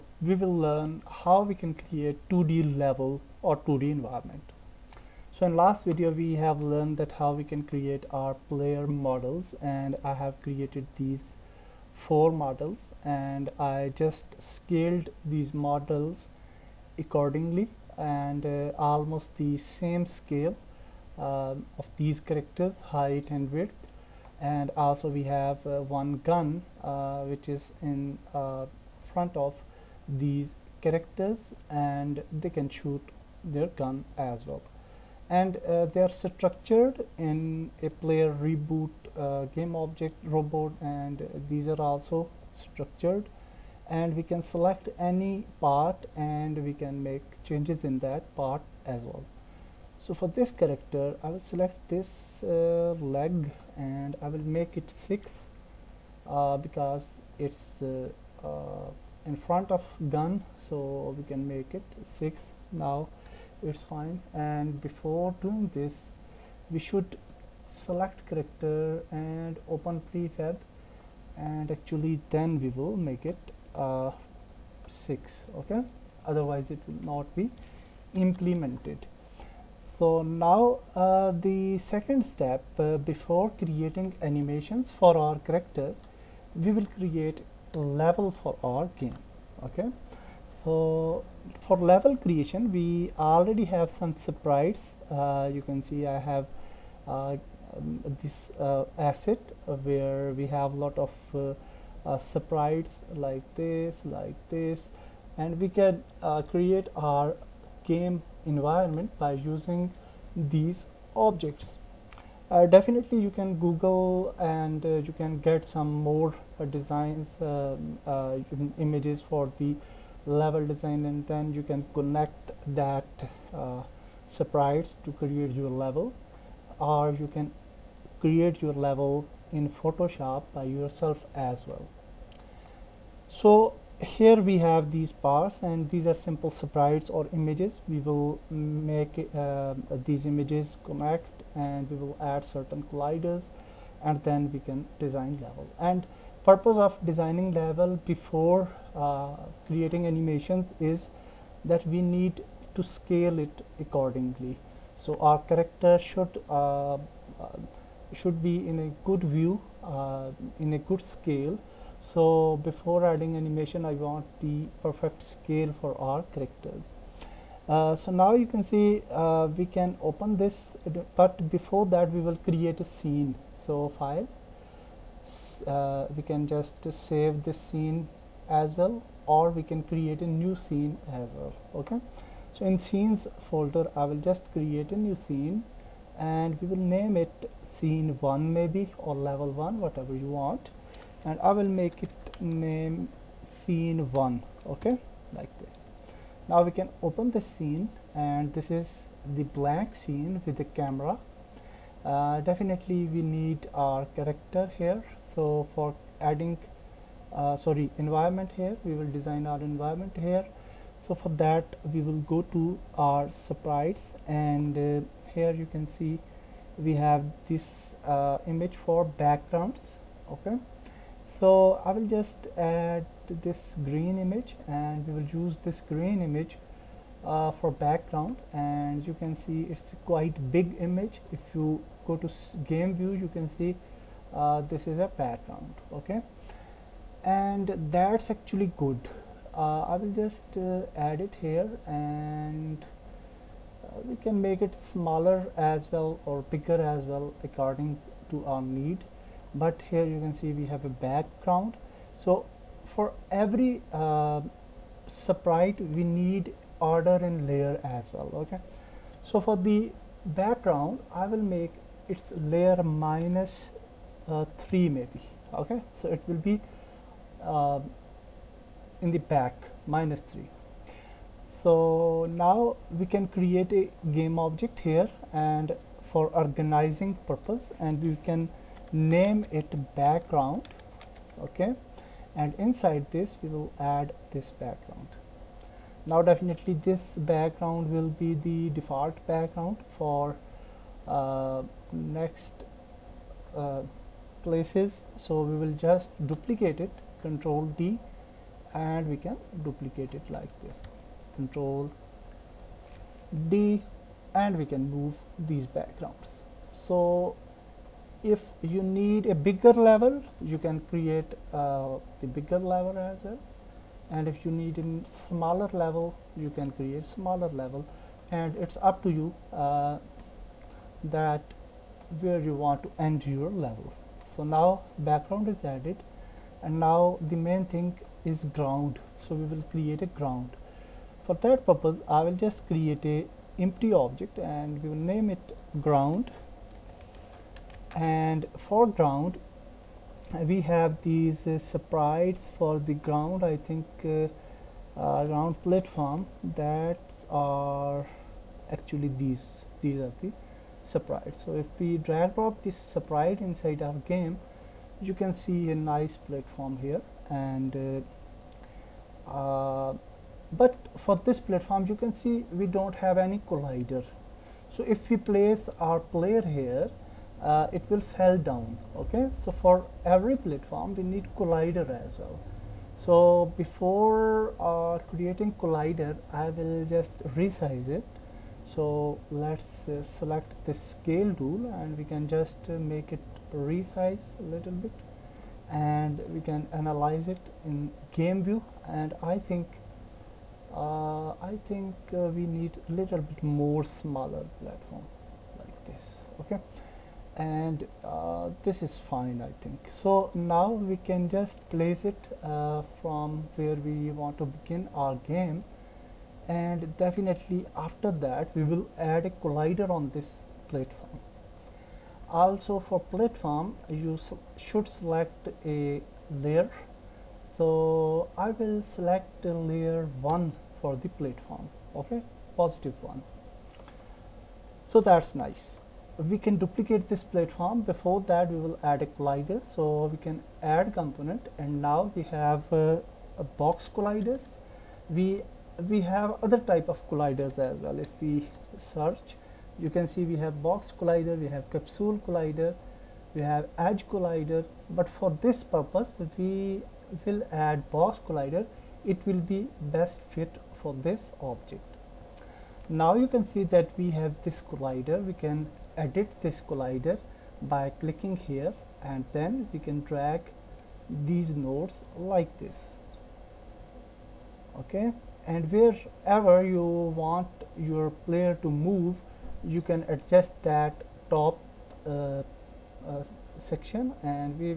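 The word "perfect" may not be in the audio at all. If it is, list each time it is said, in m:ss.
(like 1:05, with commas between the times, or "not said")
2:44.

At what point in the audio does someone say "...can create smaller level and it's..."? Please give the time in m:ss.
5:16.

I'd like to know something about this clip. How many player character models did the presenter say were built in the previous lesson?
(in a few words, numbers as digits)
4.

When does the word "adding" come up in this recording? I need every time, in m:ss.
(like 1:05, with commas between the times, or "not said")
2:43, 3:26.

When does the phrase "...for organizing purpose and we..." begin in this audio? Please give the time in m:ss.
4:36.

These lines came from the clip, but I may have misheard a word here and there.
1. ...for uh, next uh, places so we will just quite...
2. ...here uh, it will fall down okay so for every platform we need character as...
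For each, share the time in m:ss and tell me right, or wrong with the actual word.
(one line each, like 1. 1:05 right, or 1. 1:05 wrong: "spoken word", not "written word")
1. 4:49 wrong: "duplicate", not "quite"
2. 6:06 wrong: "collider", not "character".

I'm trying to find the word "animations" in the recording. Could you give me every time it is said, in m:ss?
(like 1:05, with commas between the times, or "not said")
1:24, 2:30, 2:43.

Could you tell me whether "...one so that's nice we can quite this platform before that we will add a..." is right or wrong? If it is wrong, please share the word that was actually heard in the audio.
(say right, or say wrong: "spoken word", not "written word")
wrong: "duplicate", not "quite".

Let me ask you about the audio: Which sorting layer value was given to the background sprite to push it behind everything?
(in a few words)
-3.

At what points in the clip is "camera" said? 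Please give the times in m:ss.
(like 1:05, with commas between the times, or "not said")
3:20.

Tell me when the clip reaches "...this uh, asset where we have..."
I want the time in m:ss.
1:38.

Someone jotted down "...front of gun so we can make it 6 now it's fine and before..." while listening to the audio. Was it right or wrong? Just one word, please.
right.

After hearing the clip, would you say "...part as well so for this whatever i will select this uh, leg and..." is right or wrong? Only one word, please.
wrong.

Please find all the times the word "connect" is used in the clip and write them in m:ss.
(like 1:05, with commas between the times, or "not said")
2:01, 2:20.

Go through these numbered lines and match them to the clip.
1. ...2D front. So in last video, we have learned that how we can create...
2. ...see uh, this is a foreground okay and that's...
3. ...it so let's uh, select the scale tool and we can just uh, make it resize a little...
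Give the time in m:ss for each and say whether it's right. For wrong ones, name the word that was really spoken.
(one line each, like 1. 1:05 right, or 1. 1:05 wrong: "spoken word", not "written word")
1. 0:03 wrong: "environment", not "front"
2. 3:53 wrong: "background", not "foreground"
3. 6:17 right.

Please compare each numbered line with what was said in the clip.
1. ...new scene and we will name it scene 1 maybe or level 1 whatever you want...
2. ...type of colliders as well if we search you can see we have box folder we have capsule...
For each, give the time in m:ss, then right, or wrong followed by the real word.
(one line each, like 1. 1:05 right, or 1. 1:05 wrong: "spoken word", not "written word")
1. 3:04 right
2. 7:16 wrong: "collider", not "folder".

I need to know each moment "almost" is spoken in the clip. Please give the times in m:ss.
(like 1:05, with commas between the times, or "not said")
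0:18.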